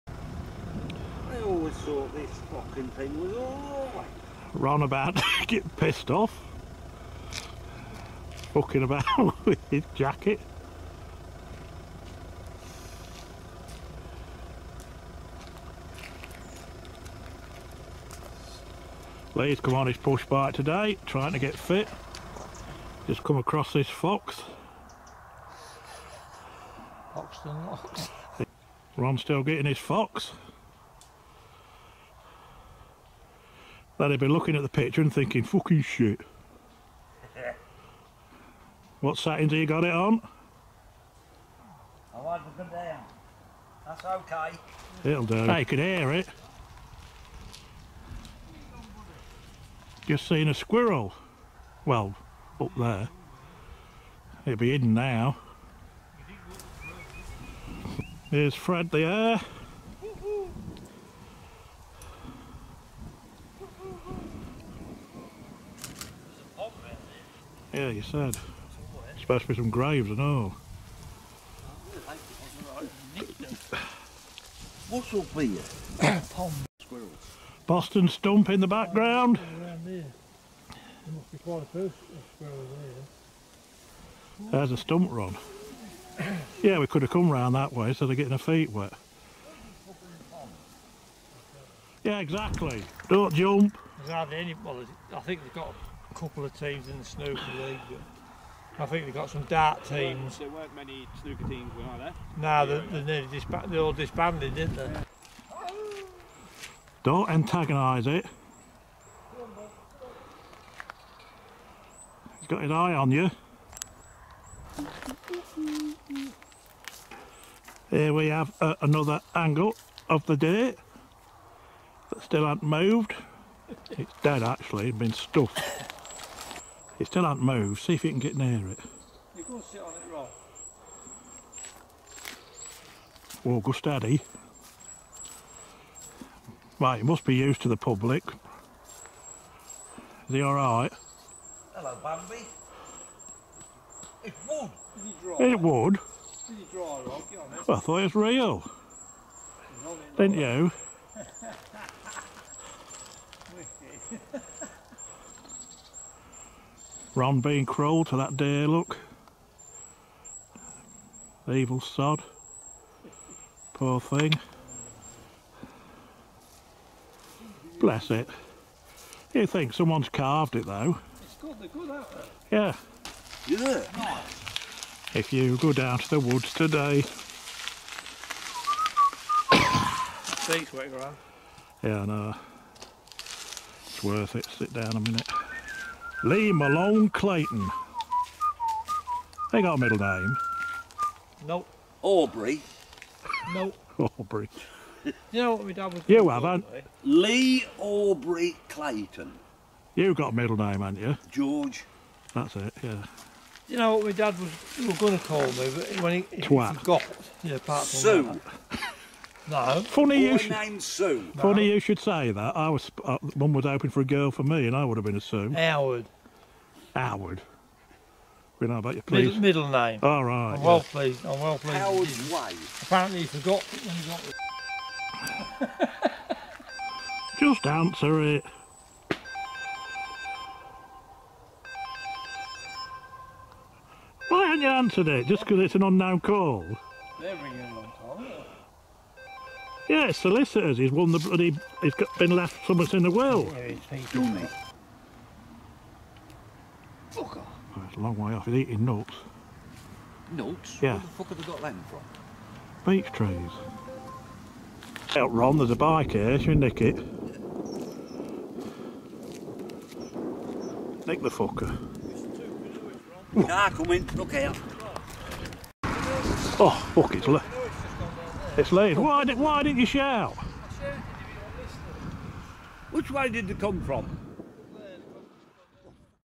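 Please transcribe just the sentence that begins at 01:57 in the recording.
Here we have uh, another angle of the day that still has not moved.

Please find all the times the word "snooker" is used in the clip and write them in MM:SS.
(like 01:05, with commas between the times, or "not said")
01:37, 01:41.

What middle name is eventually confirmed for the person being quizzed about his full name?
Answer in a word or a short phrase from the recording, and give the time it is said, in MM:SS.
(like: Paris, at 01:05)
George, at 03:21.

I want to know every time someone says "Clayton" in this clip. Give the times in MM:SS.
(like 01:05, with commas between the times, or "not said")
03:07, 03:18.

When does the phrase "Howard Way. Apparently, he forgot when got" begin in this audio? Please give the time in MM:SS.
03:41.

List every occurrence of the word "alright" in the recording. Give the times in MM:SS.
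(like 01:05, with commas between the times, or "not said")
00:03, 02:20.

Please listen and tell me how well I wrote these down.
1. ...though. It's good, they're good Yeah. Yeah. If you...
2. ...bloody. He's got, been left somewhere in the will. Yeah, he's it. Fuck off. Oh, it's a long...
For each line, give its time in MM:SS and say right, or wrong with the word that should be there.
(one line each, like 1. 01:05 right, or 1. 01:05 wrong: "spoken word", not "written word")
1. 02:50 right
2. 04:01 right.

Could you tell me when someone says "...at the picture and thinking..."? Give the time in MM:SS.
00:34.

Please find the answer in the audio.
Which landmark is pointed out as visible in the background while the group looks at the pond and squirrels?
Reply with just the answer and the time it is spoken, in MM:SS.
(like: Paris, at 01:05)
Boston Stump, at 01:17.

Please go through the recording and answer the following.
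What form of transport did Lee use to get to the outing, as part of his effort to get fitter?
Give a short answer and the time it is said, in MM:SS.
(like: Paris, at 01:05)
Push bike, at 00:19.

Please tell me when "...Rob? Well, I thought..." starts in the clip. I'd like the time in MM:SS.
02:26.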